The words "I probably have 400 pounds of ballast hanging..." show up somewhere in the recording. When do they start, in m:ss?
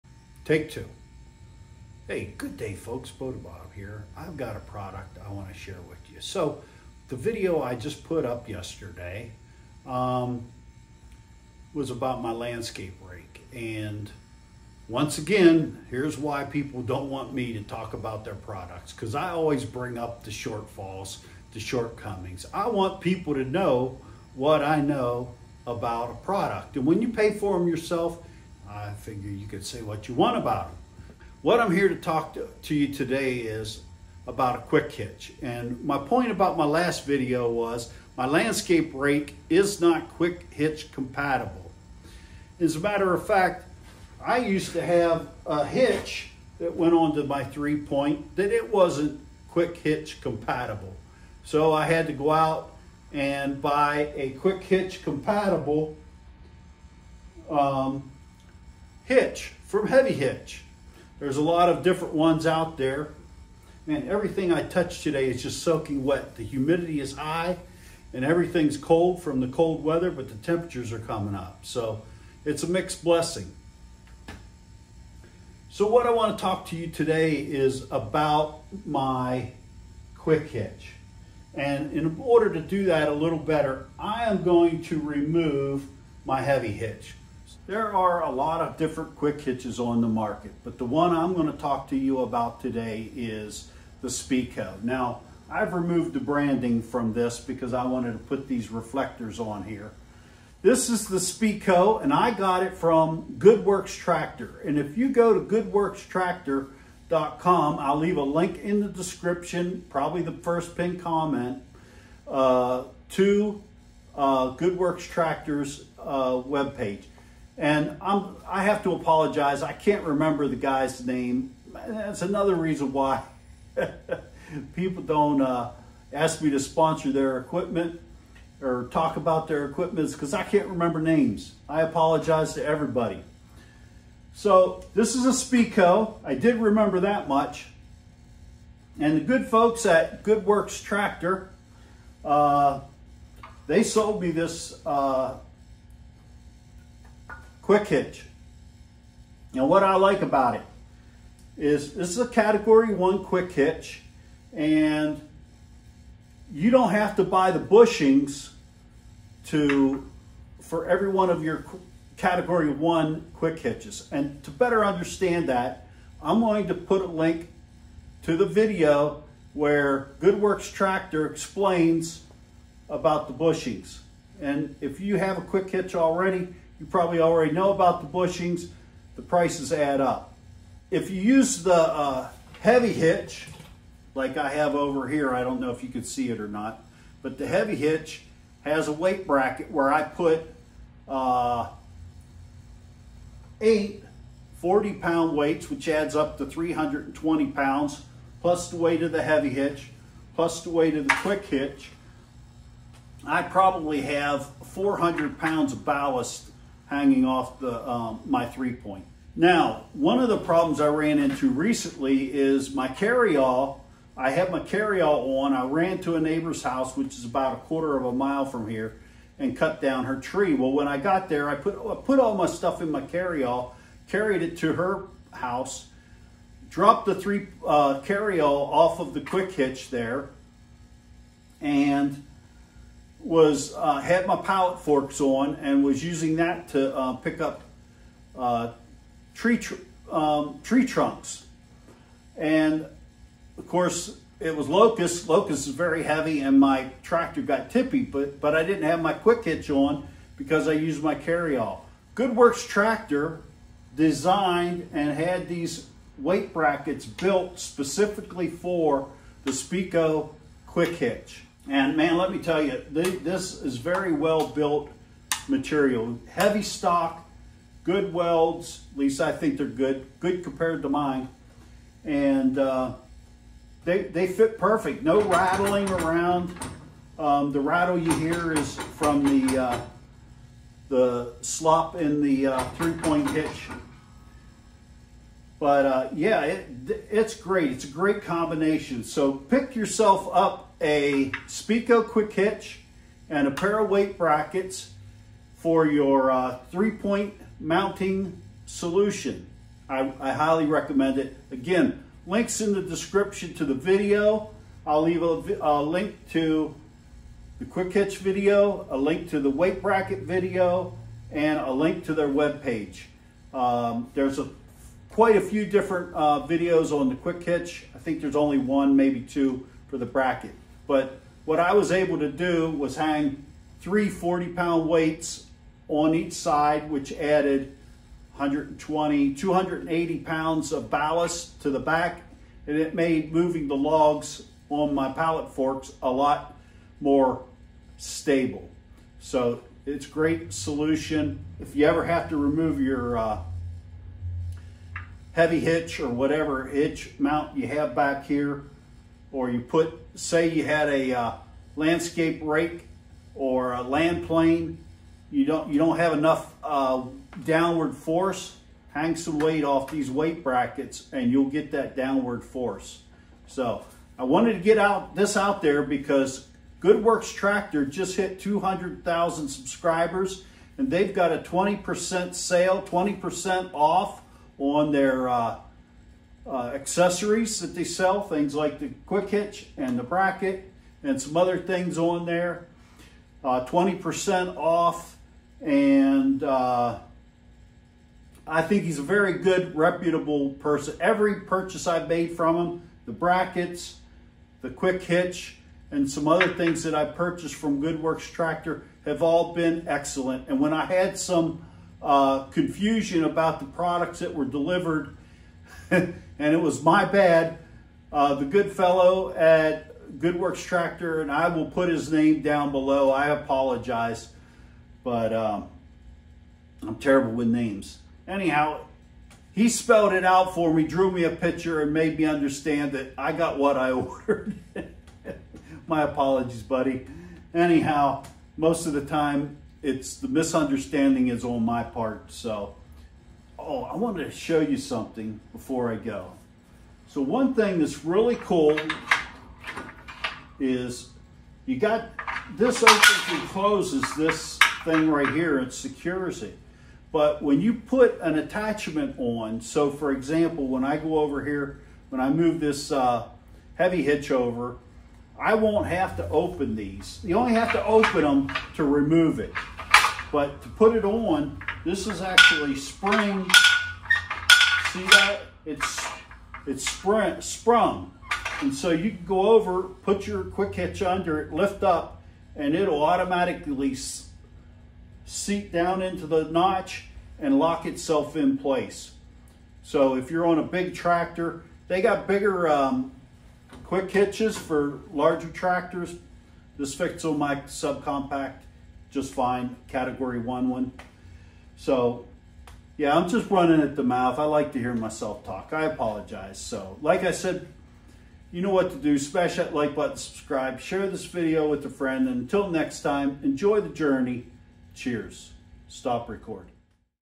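3:23.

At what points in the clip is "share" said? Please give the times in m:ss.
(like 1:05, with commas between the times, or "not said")
0:05, 8:20.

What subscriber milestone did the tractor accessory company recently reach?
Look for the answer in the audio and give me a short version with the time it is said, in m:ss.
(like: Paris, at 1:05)
200,000, at 6:08.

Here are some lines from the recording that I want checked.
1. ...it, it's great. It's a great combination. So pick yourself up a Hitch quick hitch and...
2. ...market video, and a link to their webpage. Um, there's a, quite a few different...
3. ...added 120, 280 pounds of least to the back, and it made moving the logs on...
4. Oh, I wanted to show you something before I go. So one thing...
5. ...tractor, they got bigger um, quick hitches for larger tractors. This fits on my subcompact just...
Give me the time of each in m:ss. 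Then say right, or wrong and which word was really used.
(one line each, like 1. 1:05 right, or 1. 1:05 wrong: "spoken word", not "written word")
1. 4:46 wrong: "SpeeCo", not "Hitch"
2. 5:09 wrong: "bracket", not "market"
3. 5:27 wrong: "ballast", not "least"
4. 7:13 right
5. 8:00 right.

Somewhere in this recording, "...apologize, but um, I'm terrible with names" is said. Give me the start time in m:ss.
6:53.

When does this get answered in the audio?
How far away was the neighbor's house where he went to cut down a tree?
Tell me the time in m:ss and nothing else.
3:37.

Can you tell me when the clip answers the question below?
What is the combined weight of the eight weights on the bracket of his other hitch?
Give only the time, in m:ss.
3:16.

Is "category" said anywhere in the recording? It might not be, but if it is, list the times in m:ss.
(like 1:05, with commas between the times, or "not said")
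2:32, 2:42, 8:09.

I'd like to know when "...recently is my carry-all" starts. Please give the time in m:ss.
3:31.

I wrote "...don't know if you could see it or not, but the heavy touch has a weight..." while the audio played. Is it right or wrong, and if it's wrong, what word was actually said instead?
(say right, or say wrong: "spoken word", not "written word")
wrong: "hitch", not "touch".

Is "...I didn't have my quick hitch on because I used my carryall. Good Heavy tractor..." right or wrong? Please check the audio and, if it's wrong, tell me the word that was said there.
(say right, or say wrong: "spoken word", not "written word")
wrong: "Works", not "Heavy".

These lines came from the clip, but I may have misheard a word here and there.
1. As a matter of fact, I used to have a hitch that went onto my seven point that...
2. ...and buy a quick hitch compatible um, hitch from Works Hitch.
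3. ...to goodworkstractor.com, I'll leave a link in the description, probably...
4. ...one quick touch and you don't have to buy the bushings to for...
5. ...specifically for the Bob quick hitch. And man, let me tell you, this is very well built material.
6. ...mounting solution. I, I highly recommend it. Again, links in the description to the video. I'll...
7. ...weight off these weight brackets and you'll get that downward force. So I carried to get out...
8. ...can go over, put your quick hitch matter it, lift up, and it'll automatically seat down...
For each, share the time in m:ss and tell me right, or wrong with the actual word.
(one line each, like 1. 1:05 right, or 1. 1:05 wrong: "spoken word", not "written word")
1. 0:42 wrong: "three", not "seven"
2. 0:53 wrong: "Heavy", not "Works"
3. 1:45 right
4. 2:32 wrong: "hitch", not "touch"
5. 4:17 wrong: "SpeeCo", not "Bob"
6. 4:57 right
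7. 5:59 wrong: "wanted", not "carried"
8. 7:49 wrong: "under", not "matter".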